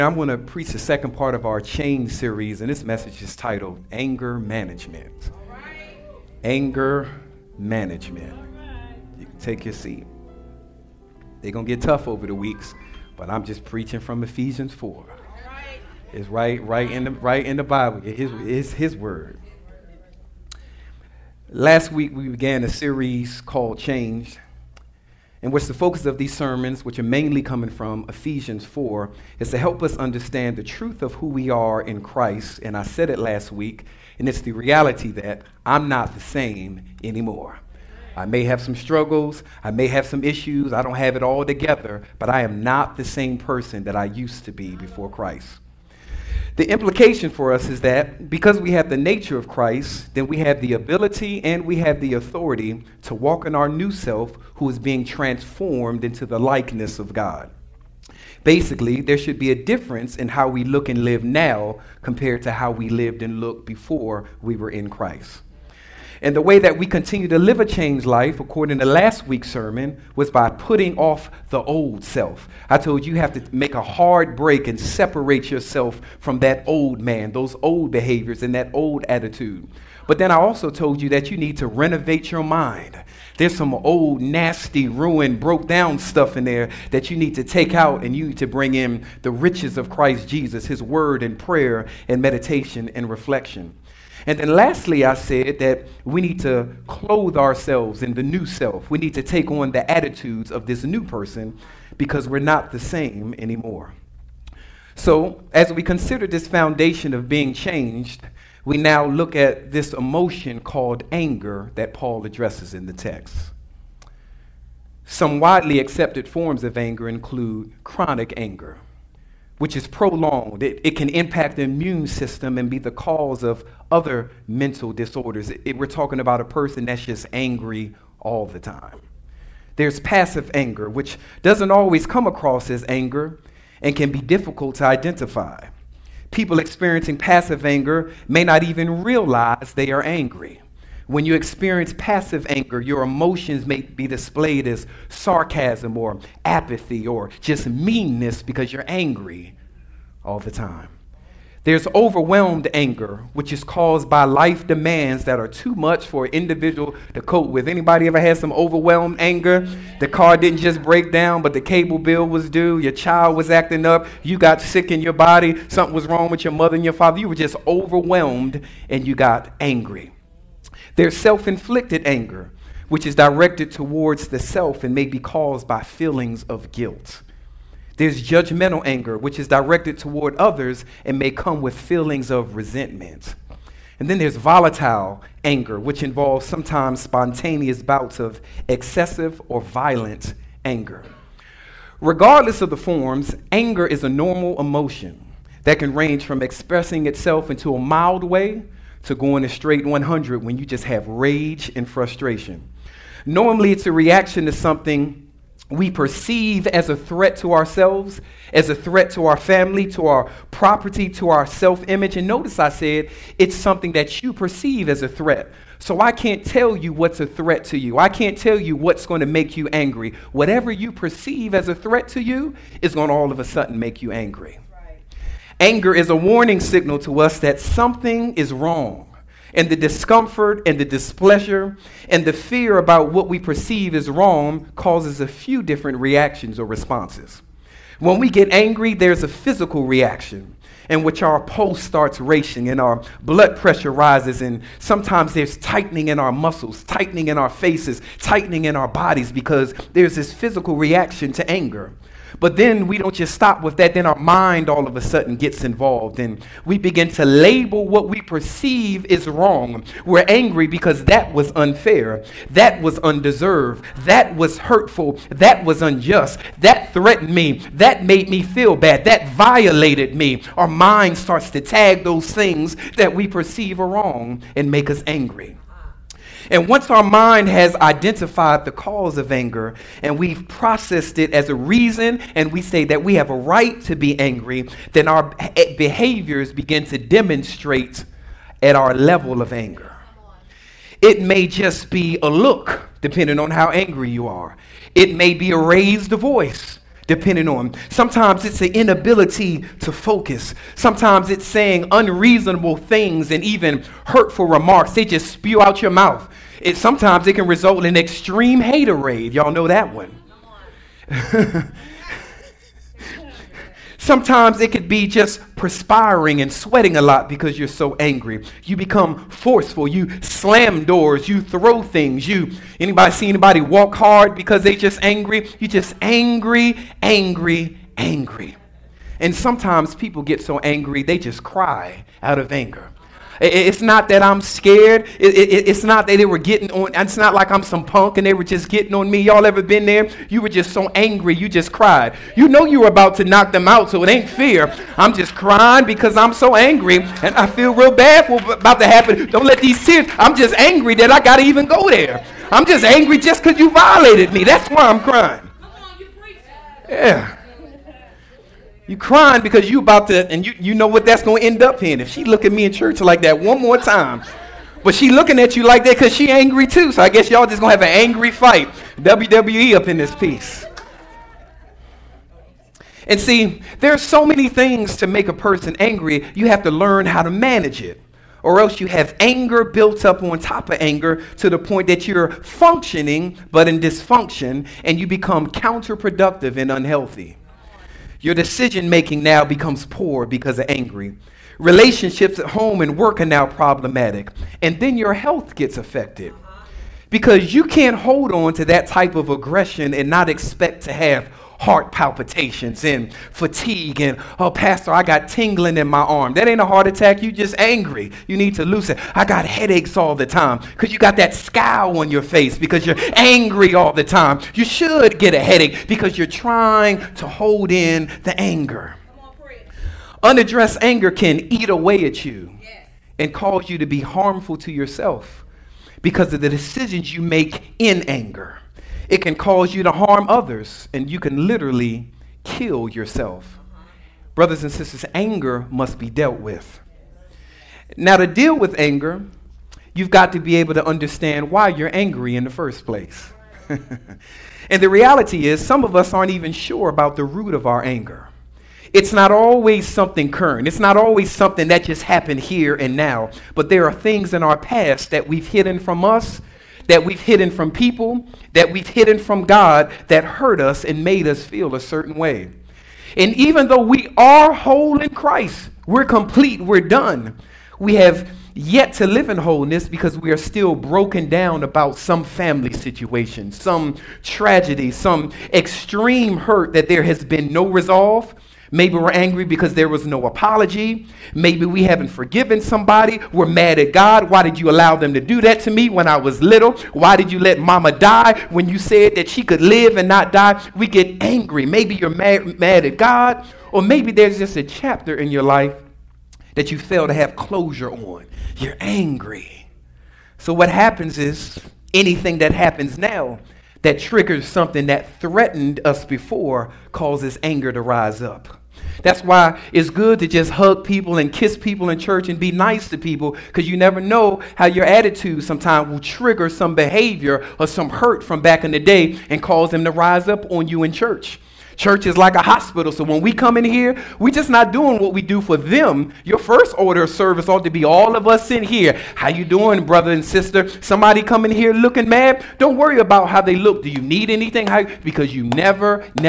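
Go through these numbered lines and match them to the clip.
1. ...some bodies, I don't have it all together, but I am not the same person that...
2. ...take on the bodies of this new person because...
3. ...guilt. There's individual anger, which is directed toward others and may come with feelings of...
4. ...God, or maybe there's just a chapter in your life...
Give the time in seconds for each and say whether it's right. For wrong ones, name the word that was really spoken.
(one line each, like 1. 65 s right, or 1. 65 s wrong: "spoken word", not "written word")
1. 40 s wrong: "issues", not "bodies"
2. 99 s wrong: "attitudes", not "bodies"
3. 176 s wrong: "judgmental", not "individual"
4. 492 s right.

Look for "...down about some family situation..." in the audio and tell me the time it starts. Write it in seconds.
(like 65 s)
471 s.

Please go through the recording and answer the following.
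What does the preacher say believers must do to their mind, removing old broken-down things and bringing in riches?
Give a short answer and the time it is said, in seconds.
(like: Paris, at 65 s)
renovate, at 81 s.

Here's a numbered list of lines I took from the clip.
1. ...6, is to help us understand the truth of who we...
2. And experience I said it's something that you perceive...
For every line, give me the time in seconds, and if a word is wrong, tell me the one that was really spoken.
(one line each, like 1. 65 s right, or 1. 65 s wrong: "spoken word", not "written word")
1. 28 s wrong: "4", not "6"
2. 212 s wrong: "notice", not "experience".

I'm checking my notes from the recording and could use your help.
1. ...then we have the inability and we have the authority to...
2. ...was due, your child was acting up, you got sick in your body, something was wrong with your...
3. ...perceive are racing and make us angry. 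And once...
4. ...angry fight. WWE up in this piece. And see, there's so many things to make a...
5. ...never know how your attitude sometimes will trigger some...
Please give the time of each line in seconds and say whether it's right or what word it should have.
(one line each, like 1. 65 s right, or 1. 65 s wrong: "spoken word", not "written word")
1. 50 s wrong: "ability", not "inability"
2. 162 s right
3. 273 s wrong: "wrong", not "racing"
4. 368 s right
5. 513 s right.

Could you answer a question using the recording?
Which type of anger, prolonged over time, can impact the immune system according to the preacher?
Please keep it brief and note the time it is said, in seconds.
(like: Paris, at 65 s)
chronic anger, at 117 s.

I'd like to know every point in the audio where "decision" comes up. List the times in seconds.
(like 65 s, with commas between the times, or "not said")
388 s, 426 s.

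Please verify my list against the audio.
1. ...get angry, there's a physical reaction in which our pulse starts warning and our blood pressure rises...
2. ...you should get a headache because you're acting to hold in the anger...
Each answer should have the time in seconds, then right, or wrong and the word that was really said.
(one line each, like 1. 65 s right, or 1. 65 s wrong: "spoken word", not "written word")
1. 238 s wrong: "racing", not "warning"
2. 414 s wrong: "trying", not "acting".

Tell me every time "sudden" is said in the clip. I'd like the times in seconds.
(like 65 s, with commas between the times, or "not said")
223 s, 255 s.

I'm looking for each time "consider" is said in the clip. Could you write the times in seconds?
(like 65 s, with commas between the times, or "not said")
105 s.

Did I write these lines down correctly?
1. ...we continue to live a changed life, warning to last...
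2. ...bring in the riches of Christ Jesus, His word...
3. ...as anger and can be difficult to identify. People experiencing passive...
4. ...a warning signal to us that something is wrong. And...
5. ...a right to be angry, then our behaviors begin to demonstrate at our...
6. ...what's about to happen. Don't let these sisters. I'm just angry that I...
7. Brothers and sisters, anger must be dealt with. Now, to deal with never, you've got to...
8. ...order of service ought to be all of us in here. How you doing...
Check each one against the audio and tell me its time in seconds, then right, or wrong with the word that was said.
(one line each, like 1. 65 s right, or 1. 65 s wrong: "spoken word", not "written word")
1. 66 s wrong: "according", not "warning"
2. 88 s right
3. 132 s right
4. 226 s right
5. 283 s right
6. 348 s wrong: "tears", not "sisters"
7. 434 s wrong: "anger", not "never"
8. 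526 s right.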